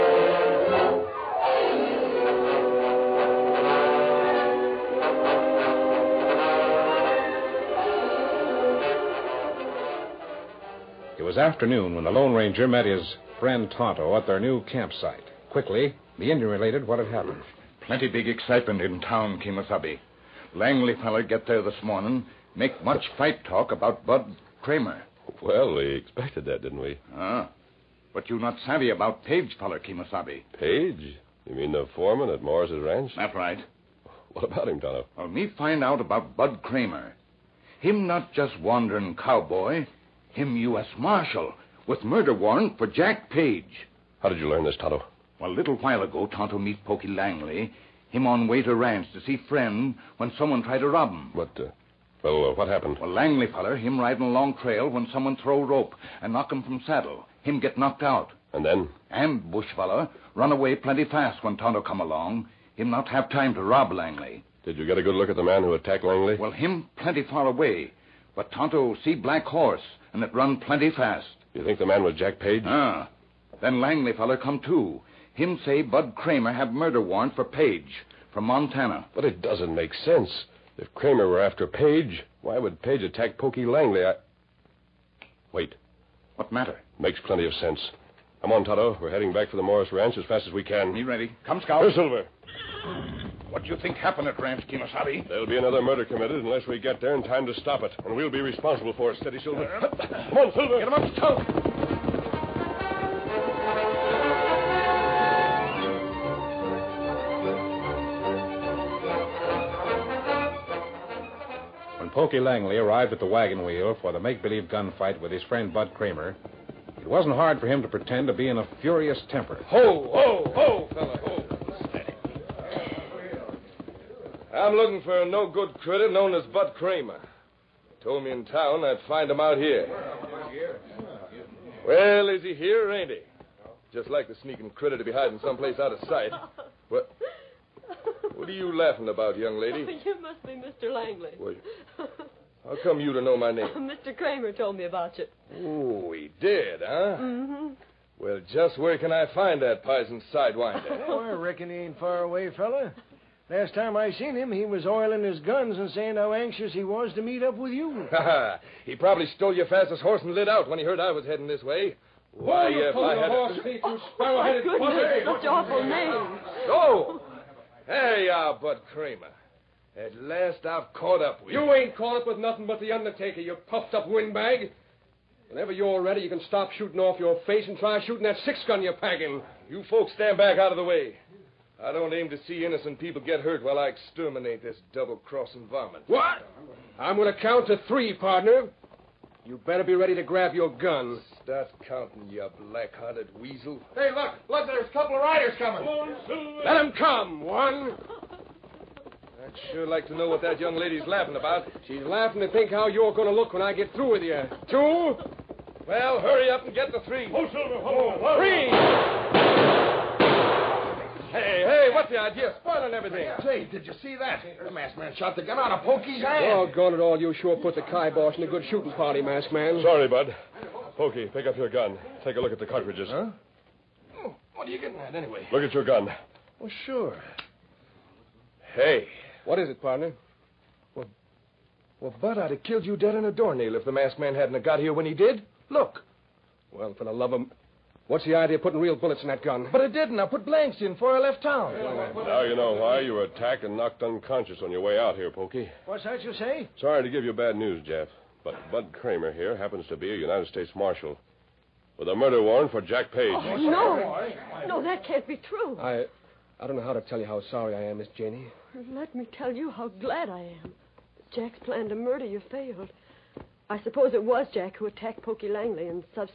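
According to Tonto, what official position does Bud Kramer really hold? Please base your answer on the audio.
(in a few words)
U.S. Marshal.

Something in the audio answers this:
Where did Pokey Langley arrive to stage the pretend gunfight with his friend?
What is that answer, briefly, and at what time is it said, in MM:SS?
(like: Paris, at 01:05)
Wagon Wheel, at 01:53.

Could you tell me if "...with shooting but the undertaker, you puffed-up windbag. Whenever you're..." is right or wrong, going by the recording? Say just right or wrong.
wrong.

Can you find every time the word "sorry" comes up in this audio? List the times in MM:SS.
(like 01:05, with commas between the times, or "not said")
03:39, 04:06, 04:17.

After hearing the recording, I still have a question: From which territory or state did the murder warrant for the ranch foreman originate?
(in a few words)
Montana.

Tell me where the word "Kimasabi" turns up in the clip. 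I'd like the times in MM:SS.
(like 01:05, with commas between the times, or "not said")
00:19, 00:29, 01:34.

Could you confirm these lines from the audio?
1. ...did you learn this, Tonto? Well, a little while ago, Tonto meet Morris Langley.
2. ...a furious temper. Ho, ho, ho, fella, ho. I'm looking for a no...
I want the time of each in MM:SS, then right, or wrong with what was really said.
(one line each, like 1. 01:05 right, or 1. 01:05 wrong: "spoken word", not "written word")
1. 00:44 wrong: "Pokey", not "Morris"
2. 01:58 right.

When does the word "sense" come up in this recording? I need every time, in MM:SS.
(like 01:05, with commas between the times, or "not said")
01:19, 01:27.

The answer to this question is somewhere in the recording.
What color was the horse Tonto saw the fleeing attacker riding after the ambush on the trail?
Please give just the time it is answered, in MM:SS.
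01:09.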